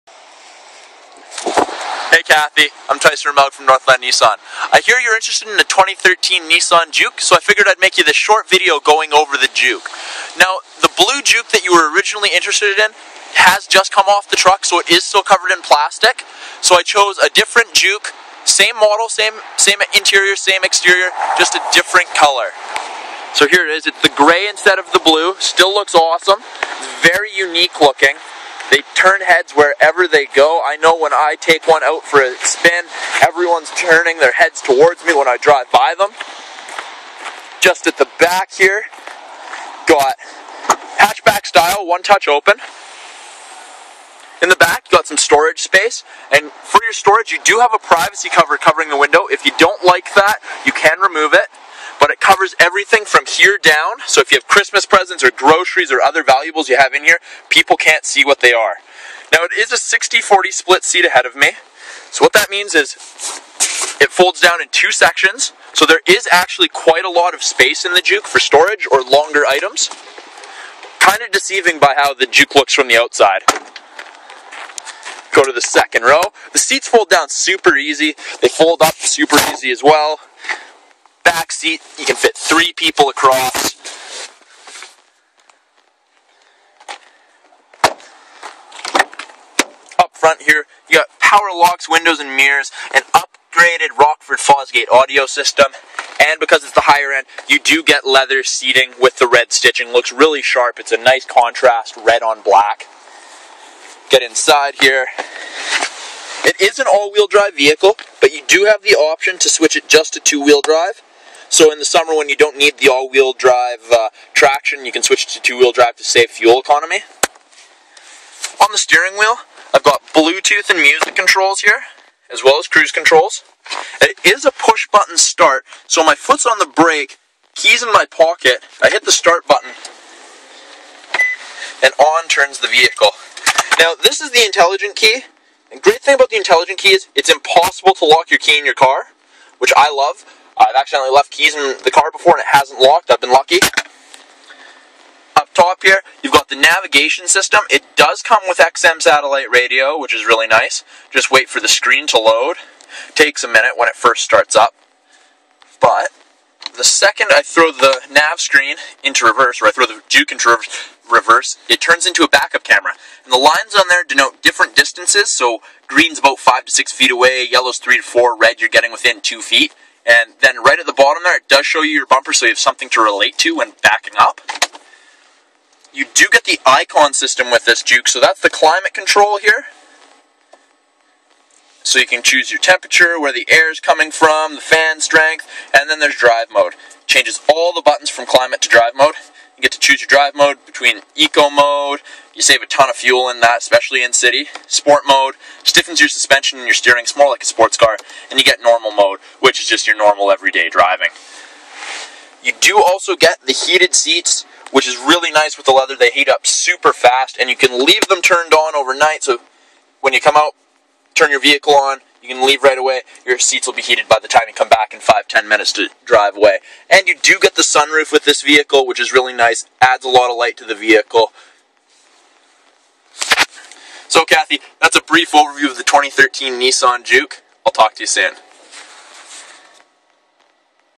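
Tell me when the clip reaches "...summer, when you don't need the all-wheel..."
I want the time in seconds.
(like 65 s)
111 s.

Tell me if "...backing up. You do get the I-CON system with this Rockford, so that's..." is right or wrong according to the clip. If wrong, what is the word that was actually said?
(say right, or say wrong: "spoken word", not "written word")
wrong: "Juke", not "Rockford".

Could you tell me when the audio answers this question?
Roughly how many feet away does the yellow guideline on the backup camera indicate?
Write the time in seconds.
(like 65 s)
167 s.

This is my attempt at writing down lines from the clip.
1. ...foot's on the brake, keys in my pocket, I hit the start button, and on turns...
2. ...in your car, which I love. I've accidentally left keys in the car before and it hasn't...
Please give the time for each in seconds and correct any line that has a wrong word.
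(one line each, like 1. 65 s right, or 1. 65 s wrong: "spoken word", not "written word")
1. 126 s right
2. 138 s right.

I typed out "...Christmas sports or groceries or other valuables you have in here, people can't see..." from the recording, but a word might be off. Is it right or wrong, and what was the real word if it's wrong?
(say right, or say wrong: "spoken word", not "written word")
wrong: "presents", not "sports".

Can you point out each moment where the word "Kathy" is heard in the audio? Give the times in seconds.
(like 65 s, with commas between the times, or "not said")
2 s, 224 s.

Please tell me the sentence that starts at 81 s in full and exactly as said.
You can fit three people across.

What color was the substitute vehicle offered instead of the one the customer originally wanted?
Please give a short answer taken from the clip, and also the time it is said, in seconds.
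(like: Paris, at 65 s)
Gray, at 24 s.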